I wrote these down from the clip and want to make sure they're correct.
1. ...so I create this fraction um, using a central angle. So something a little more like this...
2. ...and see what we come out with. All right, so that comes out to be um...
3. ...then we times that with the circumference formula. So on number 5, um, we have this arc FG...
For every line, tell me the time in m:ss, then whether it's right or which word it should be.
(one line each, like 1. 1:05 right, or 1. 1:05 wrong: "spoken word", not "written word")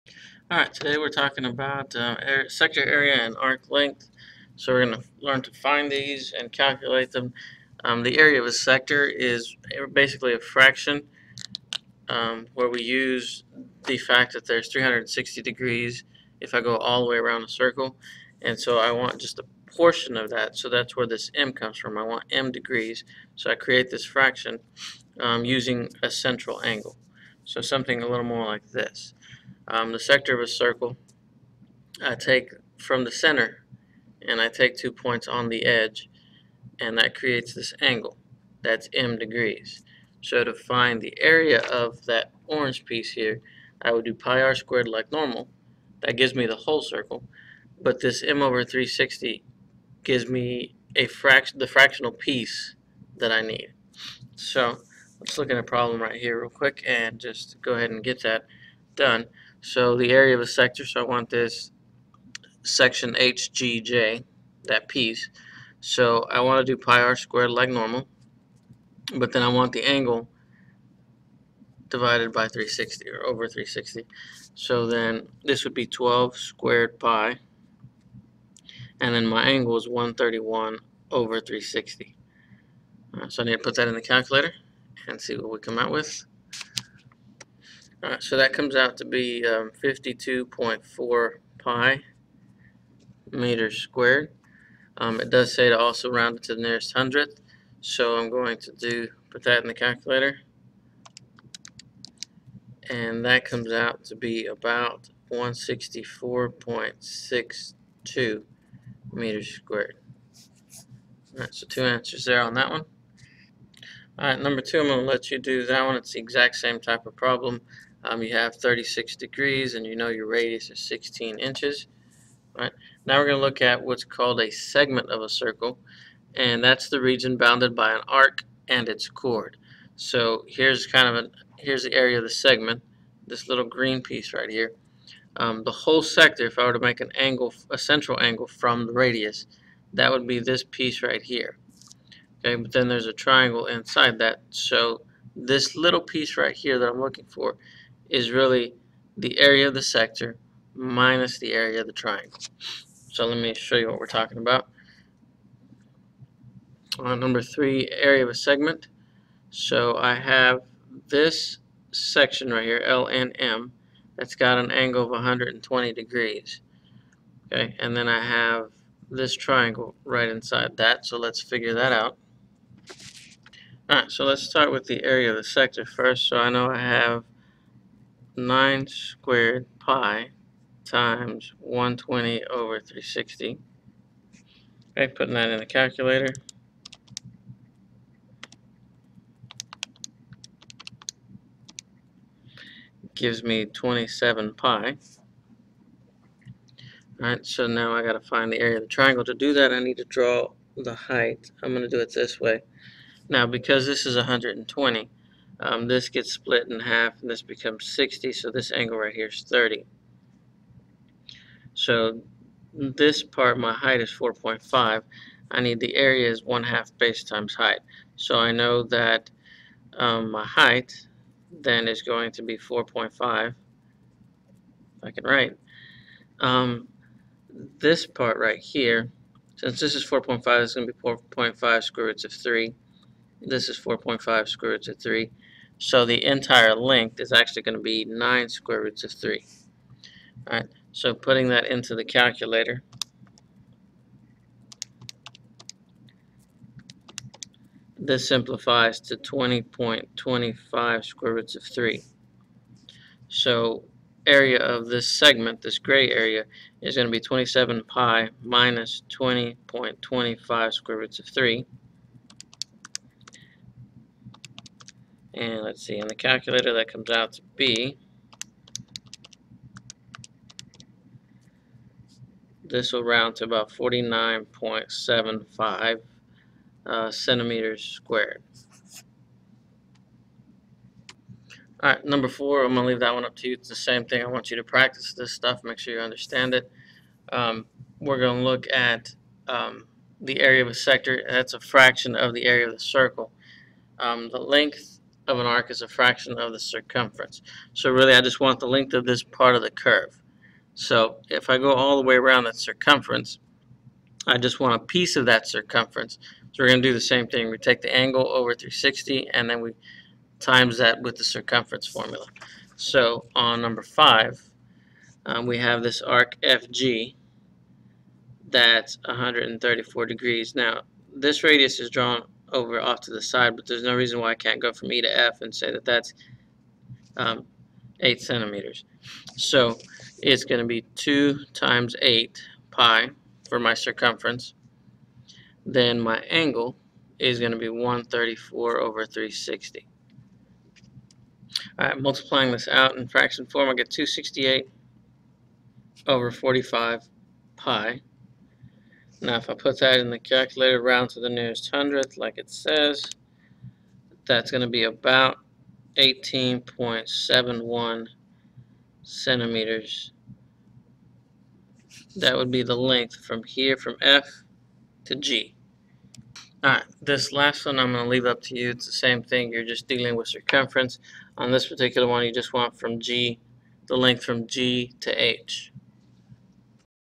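1. 0:23 right
2. 1:25 right
3. 5:09 right.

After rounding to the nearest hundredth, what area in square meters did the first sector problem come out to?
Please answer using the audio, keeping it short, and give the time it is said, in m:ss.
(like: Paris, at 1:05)
164.62, at 1:45.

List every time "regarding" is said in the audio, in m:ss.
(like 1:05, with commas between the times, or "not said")
not said.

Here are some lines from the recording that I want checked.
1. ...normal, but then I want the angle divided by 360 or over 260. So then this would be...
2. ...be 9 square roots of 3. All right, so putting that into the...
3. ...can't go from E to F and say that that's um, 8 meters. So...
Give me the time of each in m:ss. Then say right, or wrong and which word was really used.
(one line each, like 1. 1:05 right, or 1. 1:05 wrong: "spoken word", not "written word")
1. 1:07 wrong: "360", not "260"
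2. 3:57 right
3. 5:24 wrong: "centimeters", not "meters".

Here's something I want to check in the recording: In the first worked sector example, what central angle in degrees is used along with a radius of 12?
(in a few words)
131.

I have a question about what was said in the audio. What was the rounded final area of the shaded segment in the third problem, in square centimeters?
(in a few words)
49.75.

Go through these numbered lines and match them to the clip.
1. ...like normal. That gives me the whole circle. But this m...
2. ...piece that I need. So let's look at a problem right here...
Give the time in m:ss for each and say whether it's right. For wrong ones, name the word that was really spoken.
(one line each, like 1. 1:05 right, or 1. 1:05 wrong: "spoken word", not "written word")
1. 0:44 right
2. 0:52 right.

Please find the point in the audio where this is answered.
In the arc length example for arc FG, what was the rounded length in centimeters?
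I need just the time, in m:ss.
5:55.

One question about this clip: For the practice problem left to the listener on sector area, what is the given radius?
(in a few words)
16 inches.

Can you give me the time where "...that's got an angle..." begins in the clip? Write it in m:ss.
2:44.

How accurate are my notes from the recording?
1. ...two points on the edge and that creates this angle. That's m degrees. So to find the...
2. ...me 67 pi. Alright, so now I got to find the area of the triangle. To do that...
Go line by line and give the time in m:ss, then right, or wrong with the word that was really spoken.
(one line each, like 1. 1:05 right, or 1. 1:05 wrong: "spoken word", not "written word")
1. 0:34 right
2. 3:13 wrong: "27", not "67".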